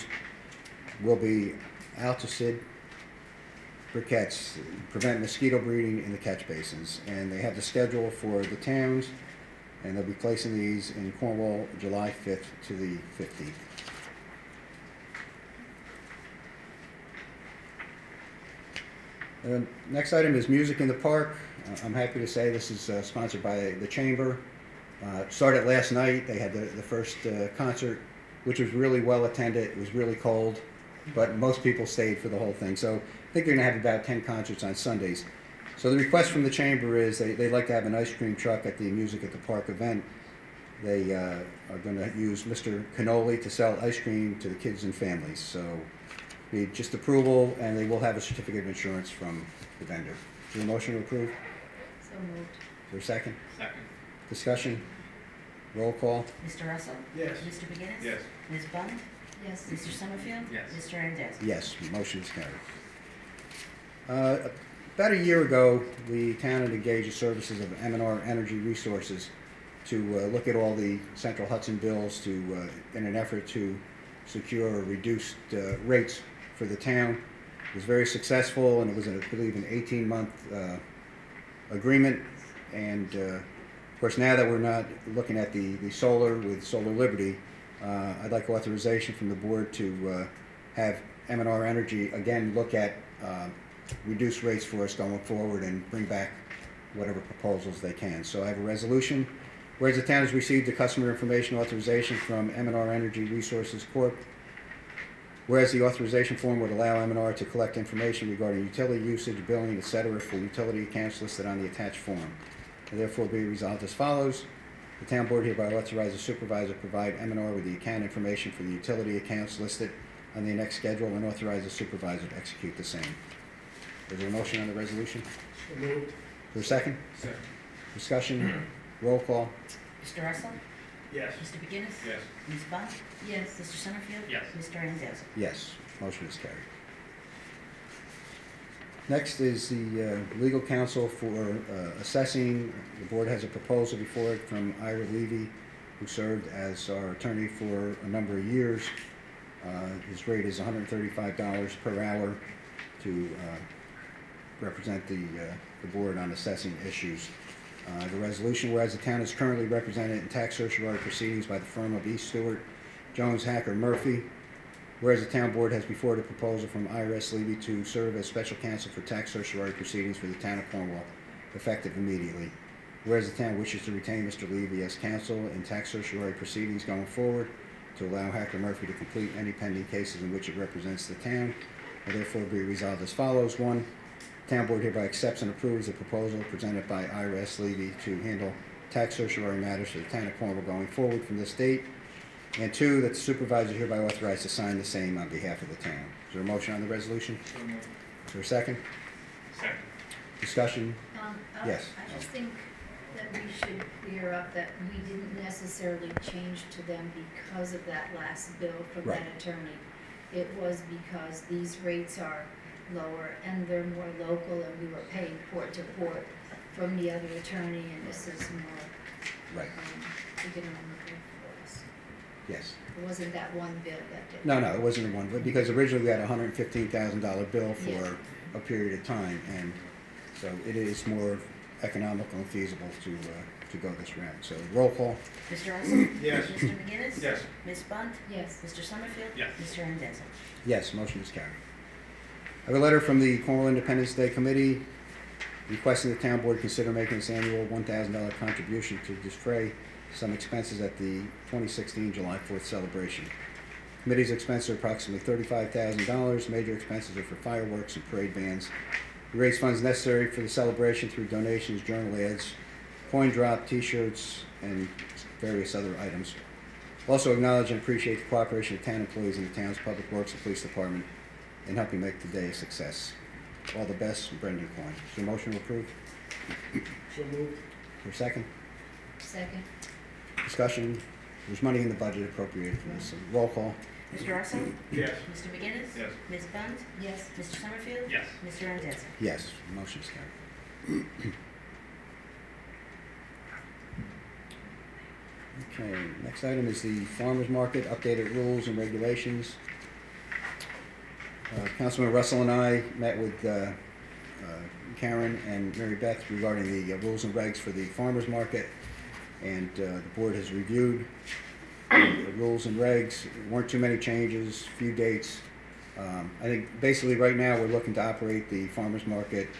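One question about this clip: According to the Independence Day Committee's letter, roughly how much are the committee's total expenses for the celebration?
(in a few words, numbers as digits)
$35,000.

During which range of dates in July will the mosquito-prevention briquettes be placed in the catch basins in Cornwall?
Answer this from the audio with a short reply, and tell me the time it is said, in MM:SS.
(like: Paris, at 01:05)
July 5 to 15, at 00:11.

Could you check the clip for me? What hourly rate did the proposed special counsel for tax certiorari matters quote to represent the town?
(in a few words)
$135.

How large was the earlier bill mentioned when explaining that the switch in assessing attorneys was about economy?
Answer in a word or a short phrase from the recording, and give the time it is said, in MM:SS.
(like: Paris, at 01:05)
$115,000, at 03:46.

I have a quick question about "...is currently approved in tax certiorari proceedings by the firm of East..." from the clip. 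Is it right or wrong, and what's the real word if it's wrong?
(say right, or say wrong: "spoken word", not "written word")
wrong: "represented", not "approved".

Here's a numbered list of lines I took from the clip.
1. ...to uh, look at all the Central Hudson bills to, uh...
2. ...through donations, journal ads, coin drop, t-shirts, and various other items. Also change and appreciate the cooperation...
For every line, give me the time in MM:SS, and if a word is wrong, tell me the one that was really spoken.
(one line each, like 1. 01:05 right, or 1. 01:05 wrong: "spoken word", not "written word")
1. 01:09 right
2. 04:21 wrong: "acknowledge", not "change".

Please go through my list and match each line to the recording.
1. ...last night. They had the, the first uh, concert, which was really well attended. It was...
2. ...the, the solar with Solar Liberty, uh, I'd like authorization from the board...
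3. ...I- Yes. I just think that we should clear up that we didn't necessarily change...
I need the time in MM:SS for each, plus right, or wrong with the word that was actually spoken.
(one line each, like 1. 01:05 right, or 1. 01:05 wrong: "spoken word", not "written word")
1. 00:25 right
2. 01:25 right
3. 03:21 right.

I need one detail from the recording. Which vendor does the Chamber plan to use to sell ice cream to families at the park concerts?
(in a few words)
Mr. Cannoli.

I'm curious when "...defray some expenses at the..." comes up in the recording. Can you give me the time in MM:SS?
04:09.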